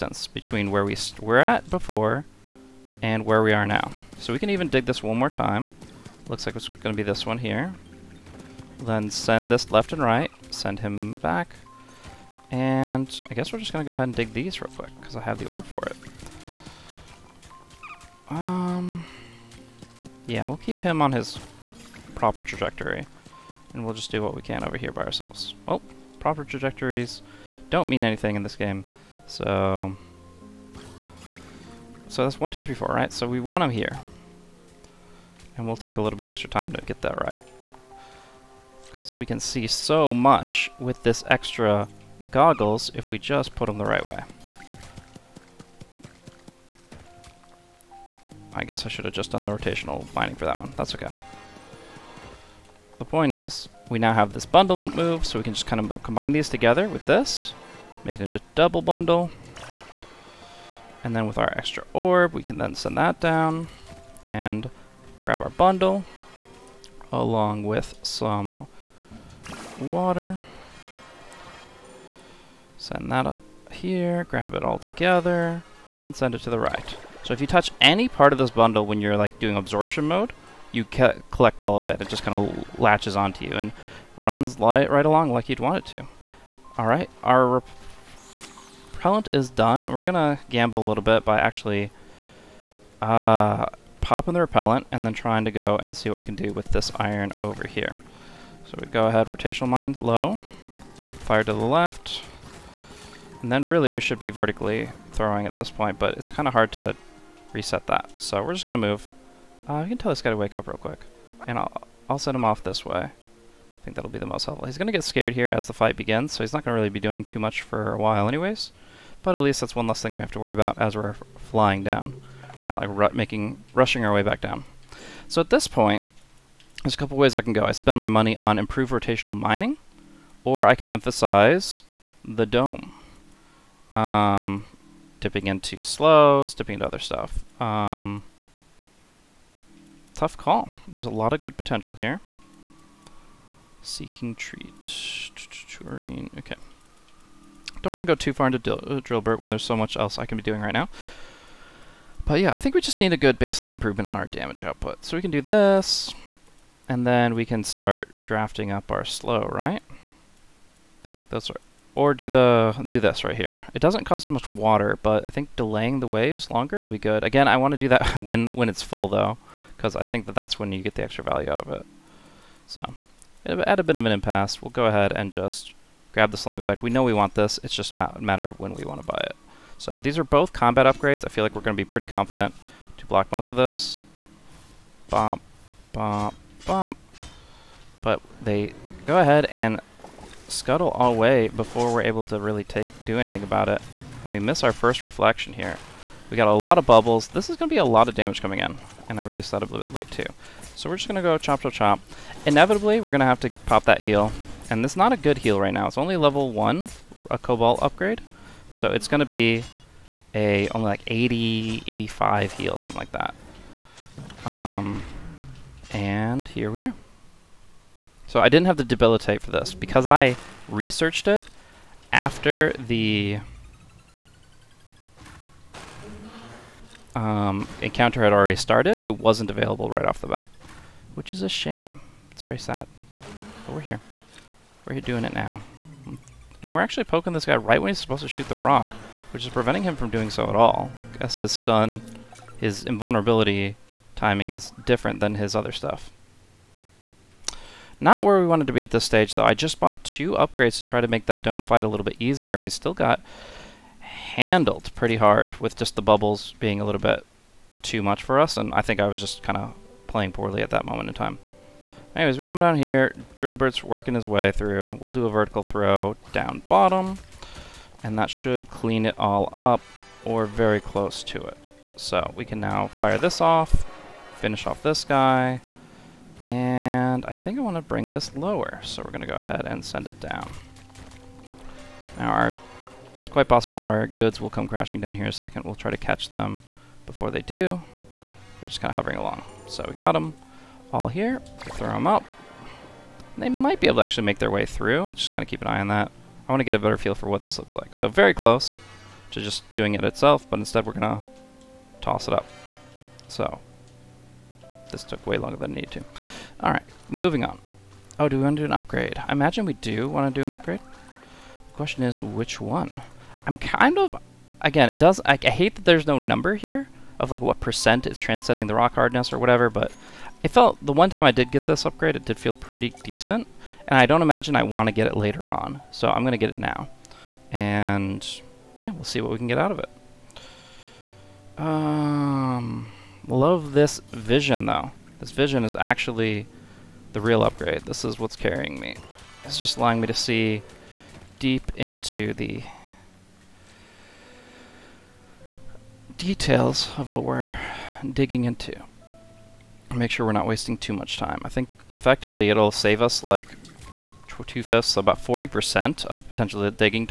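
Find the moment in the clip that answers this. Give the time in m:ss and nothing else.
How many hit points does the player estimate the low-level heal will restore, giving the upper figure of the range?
3:31.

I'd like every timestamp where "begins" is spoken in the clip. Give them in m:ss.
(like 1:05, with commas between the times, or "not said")
1:55.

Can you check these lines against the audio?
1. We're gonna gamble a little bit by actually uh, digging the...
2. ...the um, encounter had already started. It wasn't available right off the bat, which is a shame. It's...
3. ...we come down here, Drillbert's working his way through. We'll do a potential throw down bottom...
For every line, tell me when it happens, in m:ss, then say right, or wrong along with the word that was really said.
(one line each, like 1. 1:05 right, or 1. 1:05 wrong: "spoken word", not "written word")
1. 1:29 wrong: "popping", not "digging"
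2. 3:42 right
3. 4:22 wrong: "vertical", not "potential".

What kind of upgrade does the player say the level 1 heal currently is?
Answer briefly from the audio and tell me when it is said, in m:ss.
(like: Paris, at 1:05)
Cobalt upgrade, at 3:27.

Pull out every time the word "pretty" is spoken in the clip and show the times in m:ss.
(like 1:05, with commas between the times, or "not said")
3:01, 4:14, 5:22.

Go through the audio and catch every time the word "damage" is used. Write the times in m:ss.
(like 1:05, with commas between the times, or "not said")
2:34, 3:18.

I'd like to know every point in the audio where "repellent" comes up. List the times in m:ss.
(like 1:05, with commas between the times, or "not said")
1:28, 1:34.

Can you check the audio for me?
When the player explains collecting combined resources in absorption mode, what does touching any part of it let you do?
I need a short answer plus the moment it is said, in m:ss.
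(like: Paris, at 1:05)
Collect all of it, at 1:20.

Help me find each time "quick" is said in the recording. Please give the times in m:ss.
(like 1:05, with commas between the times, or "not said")
0:14, 1:50.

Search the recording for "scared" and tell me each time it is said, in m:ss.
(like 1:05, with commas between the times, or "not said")
1:55.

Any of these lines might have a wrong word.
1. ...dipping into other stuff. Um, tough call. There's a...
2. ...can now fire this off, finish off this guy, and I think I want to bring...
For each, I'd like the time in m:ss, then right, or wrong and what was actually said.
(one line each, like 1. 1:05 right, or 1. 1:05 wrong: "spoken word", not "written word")
1. 2:16 right
2. 4:32 right.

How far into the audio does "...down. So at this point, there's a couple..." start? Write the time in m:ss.
2:04.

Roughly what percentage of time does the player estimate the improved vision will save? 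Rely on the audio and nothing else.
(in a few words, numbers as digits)
40%.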